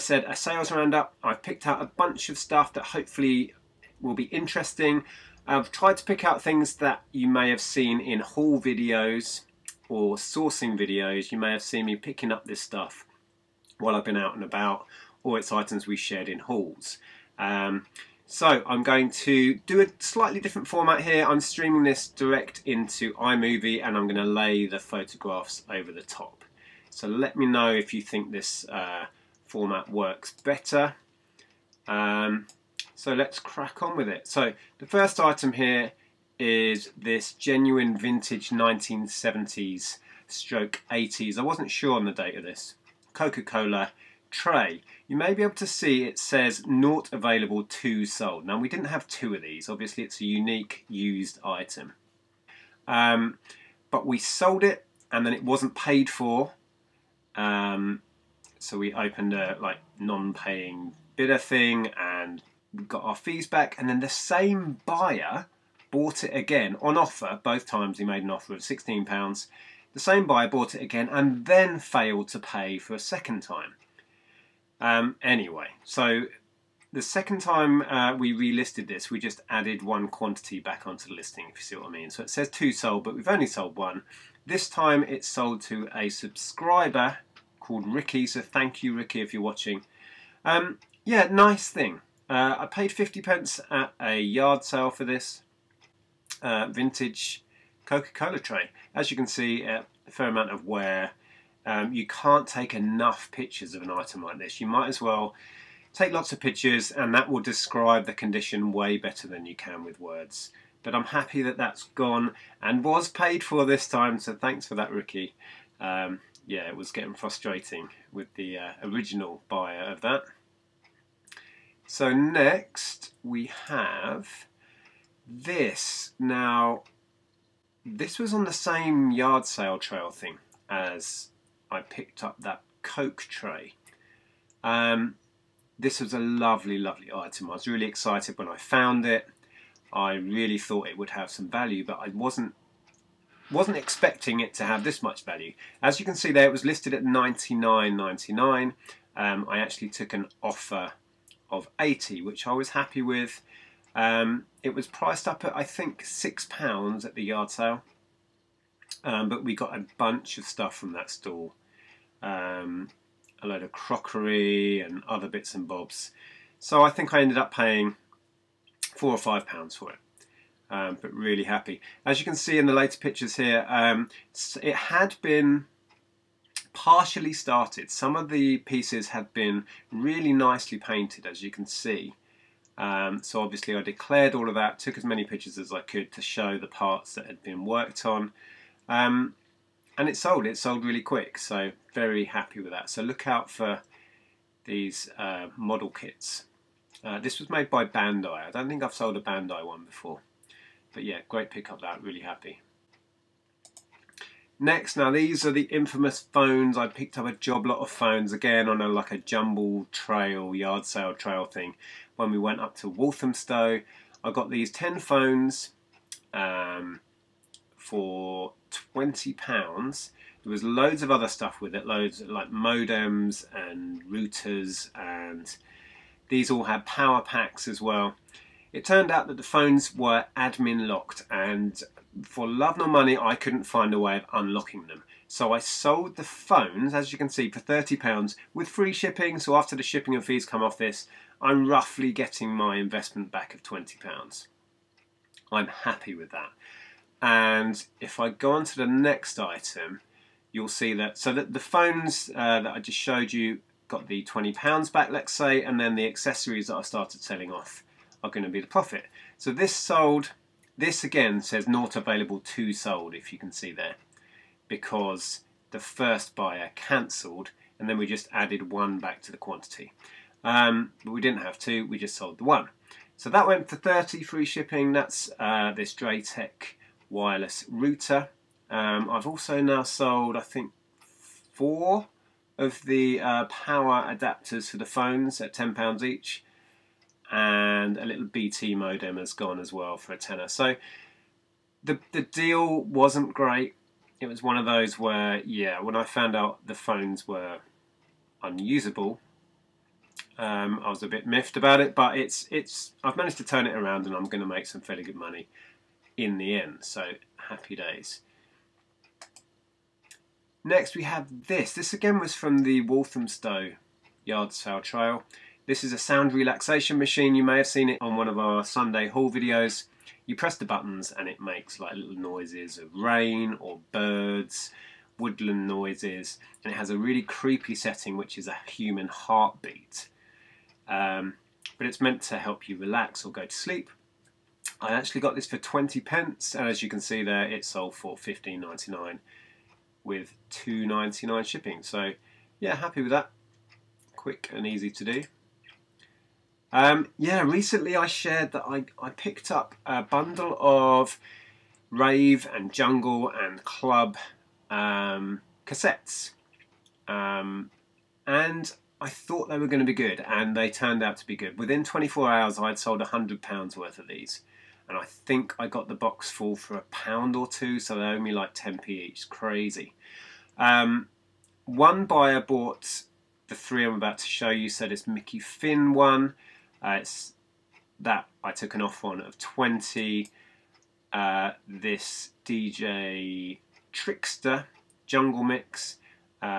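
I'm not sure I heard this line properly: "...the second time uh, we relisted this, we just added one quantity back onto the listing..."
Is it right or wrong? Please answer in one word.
right.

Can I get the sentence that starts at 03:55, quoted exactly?
So I sold the phones, as you can see, for £30 with free shipping.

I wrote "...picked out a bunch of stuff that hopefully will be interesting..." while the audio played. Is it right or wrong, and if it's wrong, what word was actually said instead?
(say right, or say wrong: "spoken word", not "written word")
right.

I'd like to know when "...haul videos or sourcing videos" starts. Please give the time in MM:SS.
00:08.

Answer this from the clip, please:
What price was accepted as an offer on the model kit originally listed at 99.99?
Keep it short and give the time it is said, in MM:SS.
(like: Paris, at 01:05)
£80, at 02:31.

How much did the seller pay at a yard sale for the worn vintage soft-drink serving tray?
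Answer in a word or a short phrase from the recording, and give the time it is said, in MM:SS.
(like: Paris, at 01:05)
50 pence, at 01:32.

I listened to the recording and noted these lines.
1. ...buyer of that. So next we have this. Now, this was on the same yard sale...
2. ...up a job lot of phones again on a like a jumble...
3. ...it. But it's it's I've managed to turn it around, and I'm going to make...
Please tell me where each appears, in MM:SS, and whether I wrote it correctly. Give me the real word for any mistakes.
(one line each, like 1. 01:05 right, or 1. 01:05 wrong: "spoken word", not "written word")
1. 01:59 right
2. 03:27 right
3. 05:01 right.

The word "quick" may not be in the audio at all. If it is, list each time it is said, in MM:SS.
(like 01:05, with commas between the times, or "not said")
03:11, 05:44.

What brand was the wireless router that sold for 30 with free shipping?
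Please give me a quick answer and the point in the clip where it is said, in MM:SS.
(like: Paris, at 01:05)
DrayTek, at 04:35.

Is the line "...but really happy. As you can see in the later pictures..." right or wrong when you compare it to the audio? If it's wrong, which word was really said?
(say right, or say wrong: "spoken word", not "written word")
right.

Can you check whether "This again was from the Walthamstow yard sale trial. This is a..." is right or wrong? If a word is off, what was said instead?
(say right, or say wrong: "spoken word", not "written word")
right.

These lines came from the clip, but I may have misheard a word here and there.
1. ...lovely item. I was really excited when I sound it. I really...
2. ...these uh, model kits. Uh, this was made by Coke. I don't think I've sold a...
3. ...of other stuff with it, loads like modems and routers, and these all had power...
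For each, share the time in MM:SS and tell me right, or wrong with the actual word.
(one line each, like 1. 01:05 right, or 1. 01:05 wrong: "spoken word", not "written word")
1. 02:16 wrong: "found", not "sound"
2. 03:14 wrong: "Bandai", not "Coke"
3. 03:41 right.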